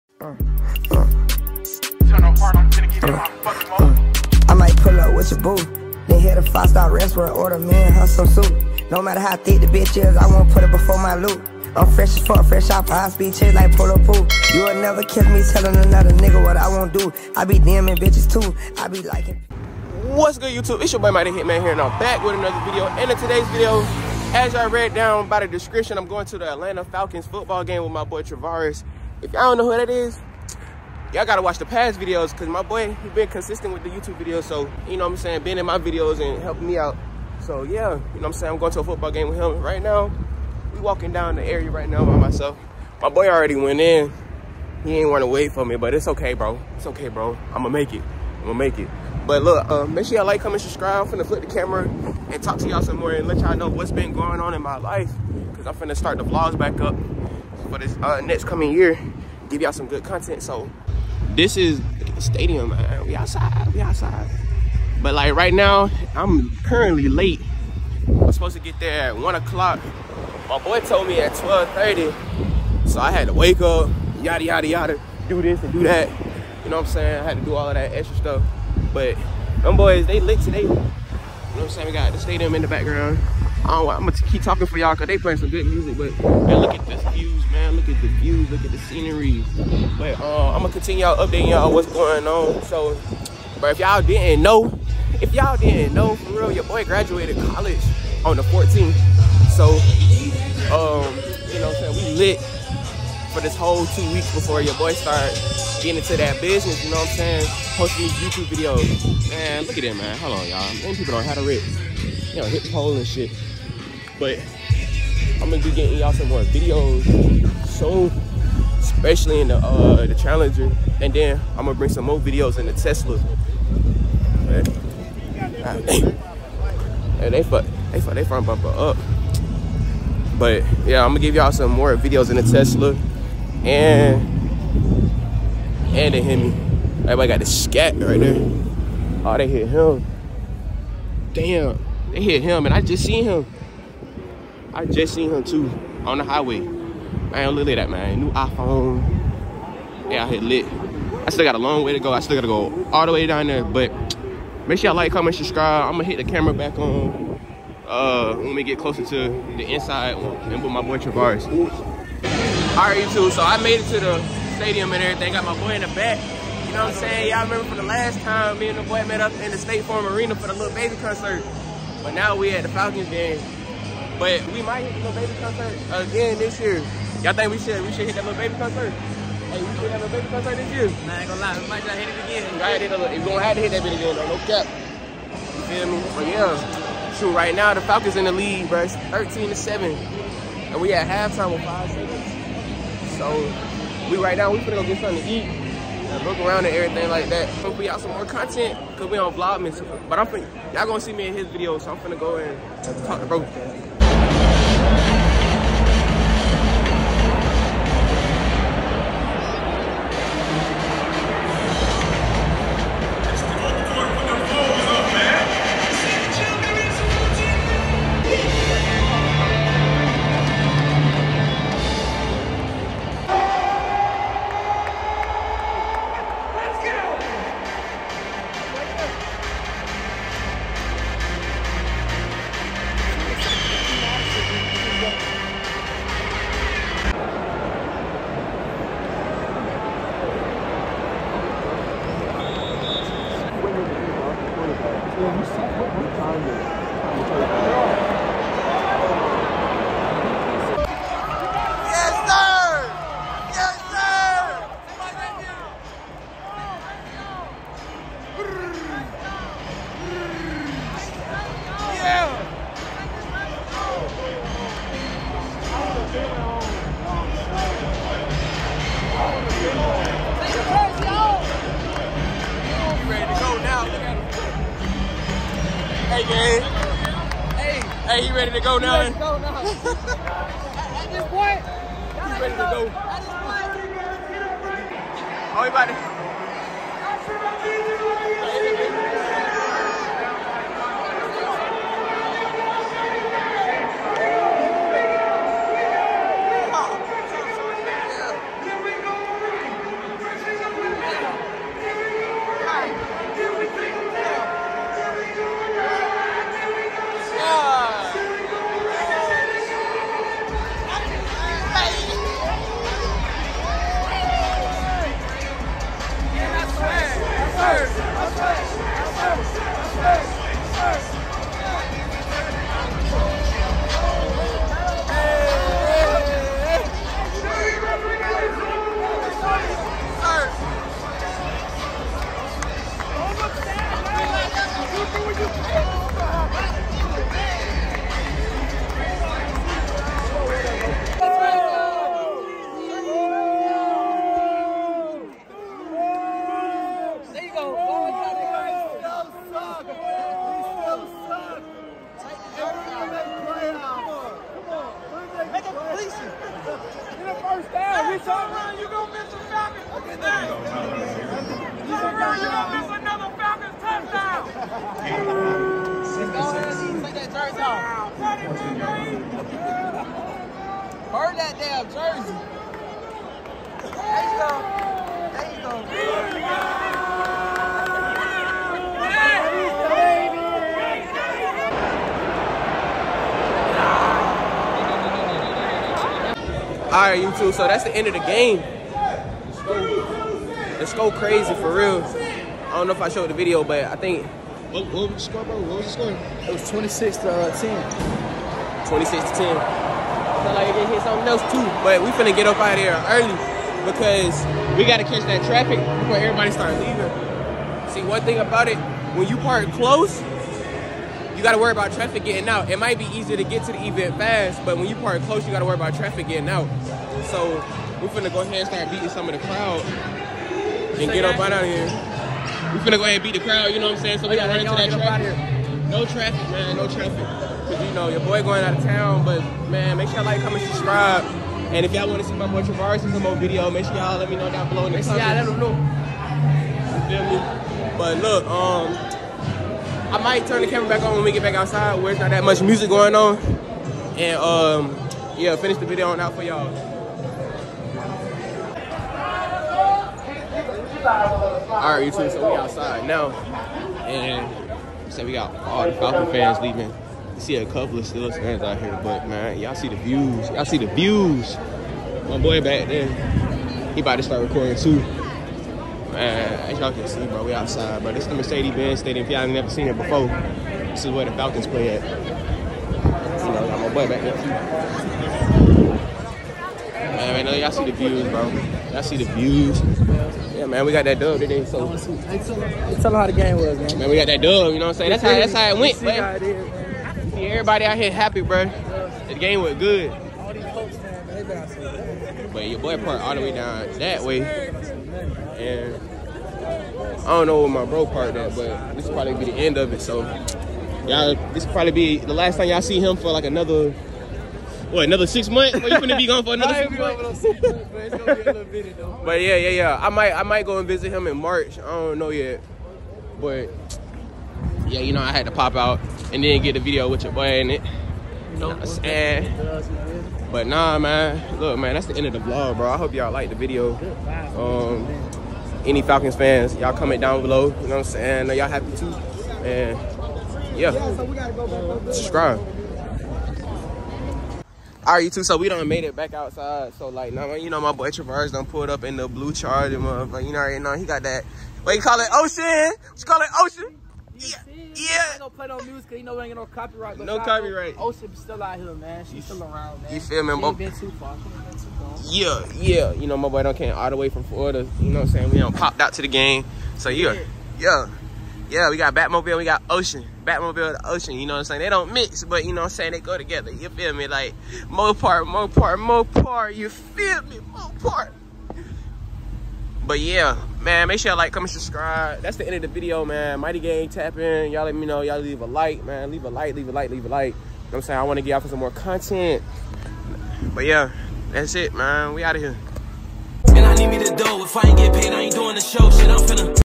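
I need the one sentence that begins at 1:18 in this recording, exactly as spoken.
But them boys, they lit today.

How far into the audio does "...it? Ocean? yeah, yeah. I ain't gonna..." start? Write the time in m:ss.
9:03.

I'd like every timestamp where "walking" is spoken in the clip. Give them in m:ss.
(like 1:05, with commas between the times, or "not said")
0:40.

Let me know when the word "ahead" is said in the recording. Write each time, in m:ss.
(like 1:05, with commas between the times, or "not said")
6:58, 7:03.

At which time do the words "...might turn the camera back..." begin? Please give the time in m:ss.
7:20.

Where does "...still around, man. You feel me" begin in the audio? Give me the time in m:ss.
9:09.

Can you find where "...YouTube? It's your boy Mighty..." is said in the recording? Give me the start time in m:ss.
0:20.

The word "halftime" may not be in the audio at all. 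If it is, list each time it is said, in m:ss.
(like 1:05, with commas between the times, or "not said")
3:11.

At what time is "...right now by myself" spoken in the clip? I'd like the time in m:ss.
0:41.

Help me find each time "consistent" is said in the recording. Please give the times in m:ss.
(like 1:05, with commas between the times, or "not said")
0:33.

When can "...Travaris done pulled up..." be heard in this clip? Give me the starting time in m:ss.
8:58.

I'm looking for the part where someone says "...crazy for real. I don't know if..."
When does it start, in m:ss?
6:31.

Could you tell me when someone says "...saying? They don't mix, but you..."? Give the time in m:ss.
9:21.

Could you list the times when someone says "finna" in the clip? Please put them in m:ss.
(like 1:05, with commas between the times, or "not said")
0:51, 0:55, 3:14, 3:21, 6:42, 6:58, 7:02.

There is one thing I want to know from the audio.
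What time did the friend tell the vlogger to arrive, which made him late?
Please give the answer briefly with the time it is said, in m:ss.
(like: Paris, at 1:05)
12:30, at 1:11.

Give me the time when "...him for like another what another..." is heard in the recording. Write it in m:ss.
8:22.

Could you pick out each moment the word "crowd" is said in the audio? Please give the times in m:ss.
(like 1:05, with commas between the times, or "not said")
6:59, 7:03.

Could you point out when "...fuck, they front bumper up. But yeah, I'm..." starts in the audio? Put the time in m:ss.
2:08.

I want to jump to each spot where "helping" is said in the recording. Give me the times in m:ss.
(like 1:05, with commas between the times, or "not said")
0:36.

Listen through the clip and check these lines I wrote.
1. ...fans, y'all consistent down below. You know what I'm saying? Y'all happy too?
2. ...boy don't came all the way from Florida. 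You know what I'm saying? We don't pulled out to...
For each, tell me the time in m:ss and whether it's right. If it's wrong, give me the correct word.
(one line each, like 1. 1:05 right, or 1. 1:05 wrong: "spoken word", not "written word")
1. 8:46 wrong: "comment", not "consistent"
2. 9:13 wrong: "popped", not "pulled".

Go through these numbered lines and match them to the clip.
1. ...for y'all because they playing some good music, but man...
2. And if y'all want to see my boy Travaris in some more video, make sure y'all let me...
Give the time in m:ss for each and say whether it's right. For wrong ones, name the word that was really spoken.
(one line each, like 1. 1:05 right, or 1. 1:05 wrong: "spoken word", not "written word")
1. 1:24 right
2. 7:11 right.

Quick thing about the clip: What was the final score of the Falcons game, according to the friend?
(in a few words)
26 to 10.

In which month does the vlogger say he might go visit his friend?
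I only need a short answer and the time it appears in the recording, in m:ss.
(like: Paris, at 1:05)
March, at 8:31.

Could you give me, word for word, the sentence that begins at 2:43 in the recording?
So I made it to the stadium and everything.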